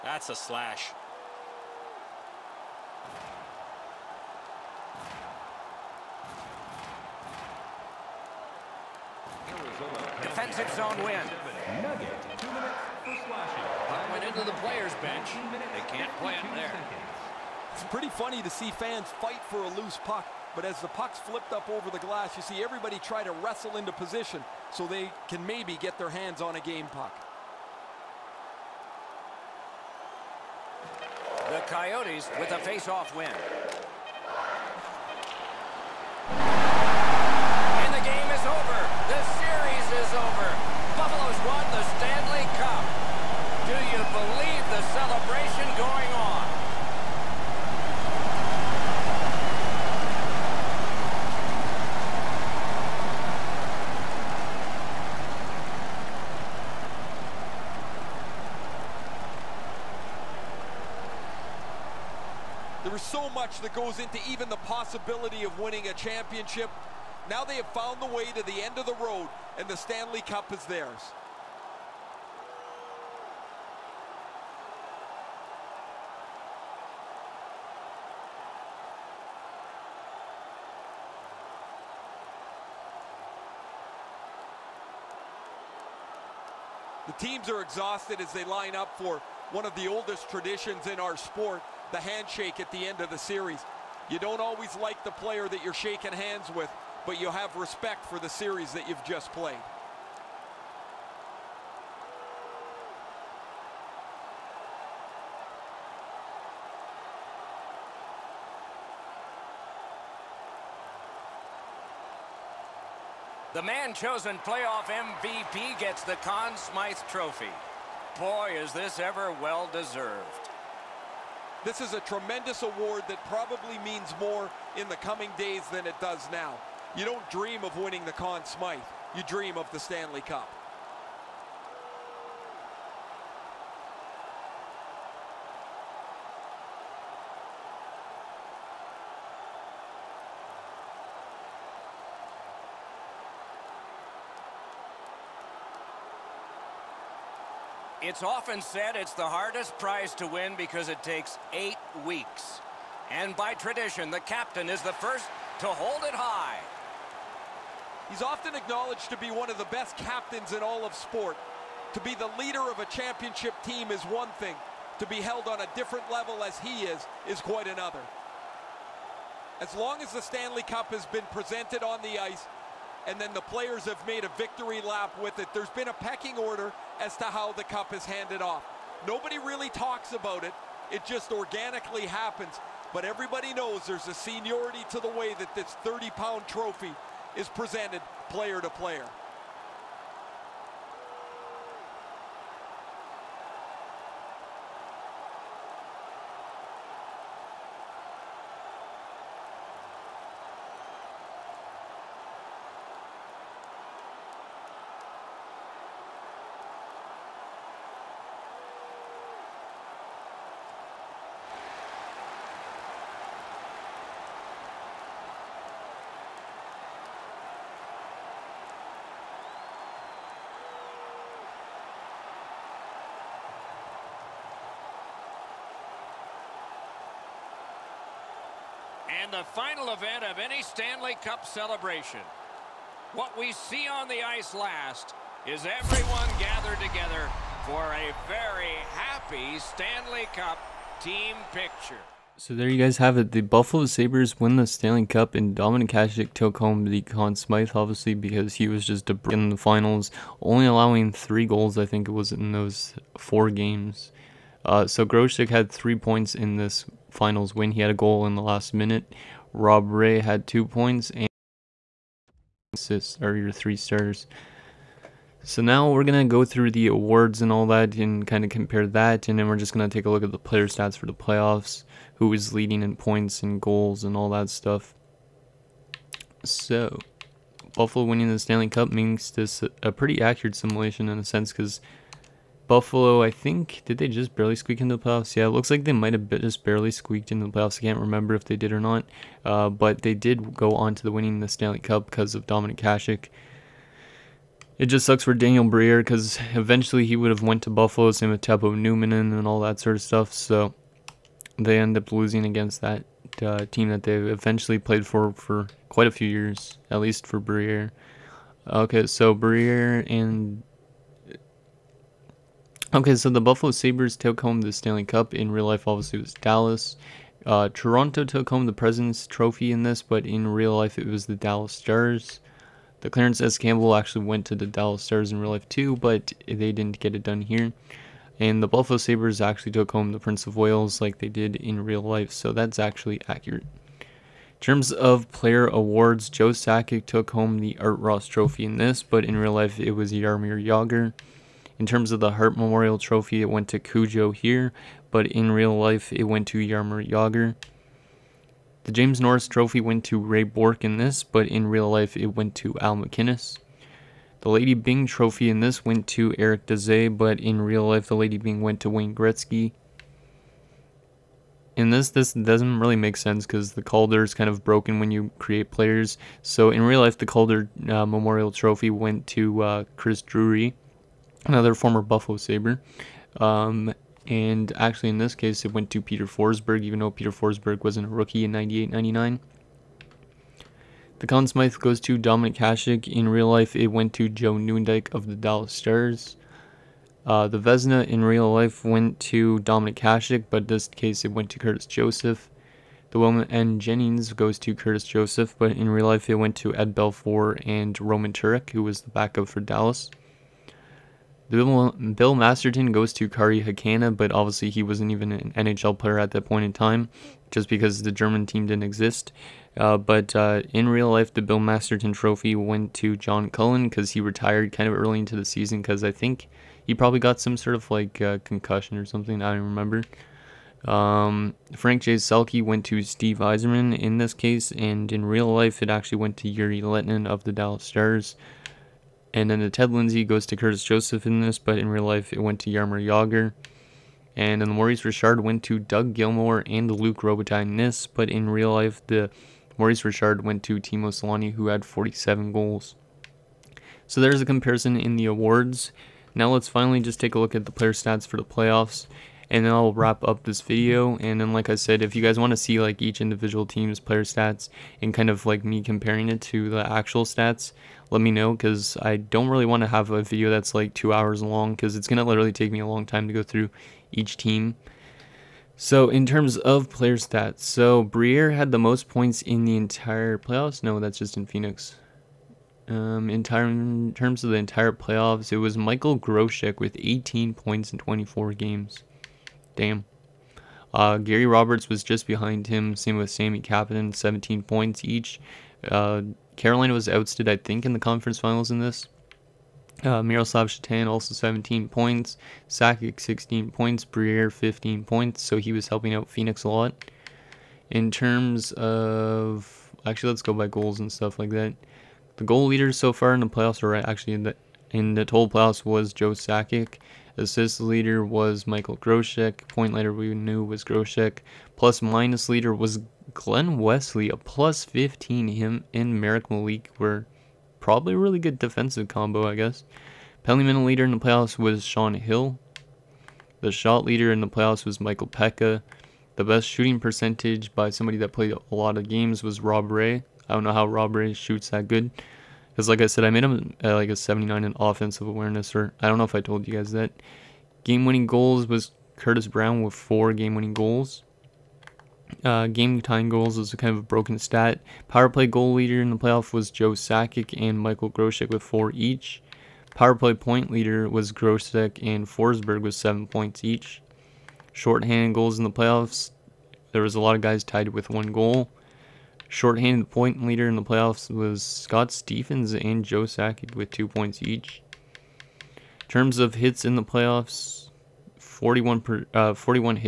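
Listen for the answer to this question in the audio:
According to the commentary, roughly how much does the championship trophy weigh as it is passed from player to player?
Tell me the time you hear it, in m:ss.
3:05.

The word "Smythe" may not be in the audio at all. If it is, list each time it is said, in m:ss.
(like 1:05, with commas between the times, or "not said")
1:56, 2:08, 4:07, 6:21.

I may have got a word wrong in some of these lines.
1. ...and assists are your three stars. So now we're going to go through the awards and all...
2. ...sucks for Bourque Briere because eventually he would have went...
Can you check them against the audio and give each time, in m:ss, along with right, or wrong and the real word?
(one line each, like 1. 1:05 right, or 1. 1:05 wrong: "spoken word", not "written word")
1. 4:21 right
2. 4:55 wrong: "Daniel", not "Bourque".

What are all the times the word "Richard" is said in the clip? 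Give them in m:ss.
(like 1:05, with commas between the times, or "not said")
7:15, 7:20.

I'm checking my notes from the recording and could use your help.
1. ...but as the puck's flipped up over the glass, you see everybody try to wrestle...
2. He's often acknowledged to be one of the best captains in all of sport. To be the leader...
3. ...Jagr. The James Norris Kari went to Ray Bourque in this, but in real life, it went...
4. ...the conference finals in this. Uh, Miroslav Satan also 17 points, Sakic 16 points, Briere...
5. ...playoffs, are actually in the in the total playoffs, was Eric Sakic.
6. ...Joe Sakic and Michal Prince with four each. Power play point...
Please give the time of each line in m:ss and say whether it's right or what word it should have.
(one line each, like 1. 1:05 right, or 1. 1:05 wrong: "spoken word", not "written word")
1. 0:20 right
2. 2:38 right
3. 5:47 wrong: "Trophy", not "Kari"
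4. 8:07 right
5. 8:23 wrong: "Joe", not "Eric"
6. 9:06 wrong: "Grosek", not "Prince".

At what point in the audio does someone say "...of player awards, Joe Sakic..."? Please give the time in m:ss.
5:34.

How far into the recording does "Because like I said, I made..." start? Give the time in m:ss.
8:52.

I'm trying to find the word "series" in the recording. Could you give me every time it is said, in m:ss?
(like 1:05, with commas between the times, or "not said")
1:33, 1:38.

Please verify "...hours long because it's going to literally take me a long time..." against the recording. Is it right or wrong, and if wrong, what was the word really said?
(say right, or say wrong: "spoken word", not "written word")
right.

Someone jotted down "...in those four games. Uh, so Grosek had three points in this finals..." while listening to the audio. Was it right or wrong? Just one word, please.
right.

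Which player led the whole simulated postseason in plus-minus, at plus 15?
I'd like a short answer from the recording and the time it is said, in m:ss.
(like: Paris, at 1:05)
Glen Wesley, at 8:33.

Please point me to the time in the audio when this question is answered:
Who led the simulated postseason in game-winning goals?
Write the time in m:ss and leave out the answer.
8:59.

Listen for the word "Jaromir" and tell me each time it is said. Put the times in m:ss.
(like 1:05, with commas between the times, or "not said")
5:40, 5:46, 7:12.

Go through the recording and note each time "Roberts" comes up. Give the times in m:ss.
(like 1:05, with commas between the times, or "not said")
8:01.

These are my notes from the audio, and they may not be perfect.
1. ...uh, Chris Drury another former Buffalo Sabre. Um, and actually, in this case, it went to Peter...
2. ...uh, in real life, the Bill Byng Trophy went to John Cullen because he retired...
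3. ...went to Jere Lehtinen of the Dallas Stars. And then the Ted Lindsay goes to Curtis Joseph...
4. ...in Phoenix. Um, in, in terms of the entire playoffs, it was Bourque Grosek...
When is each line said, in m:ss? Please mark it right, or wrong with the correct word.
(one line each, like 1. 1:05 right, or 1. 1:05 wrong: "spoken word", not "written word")
1. 6:09 right
2. 6:50 wrong: "Masterton", not "Byng"
3. 7:06 right
4. 7:51 wrong: "Michal", not "Bourque".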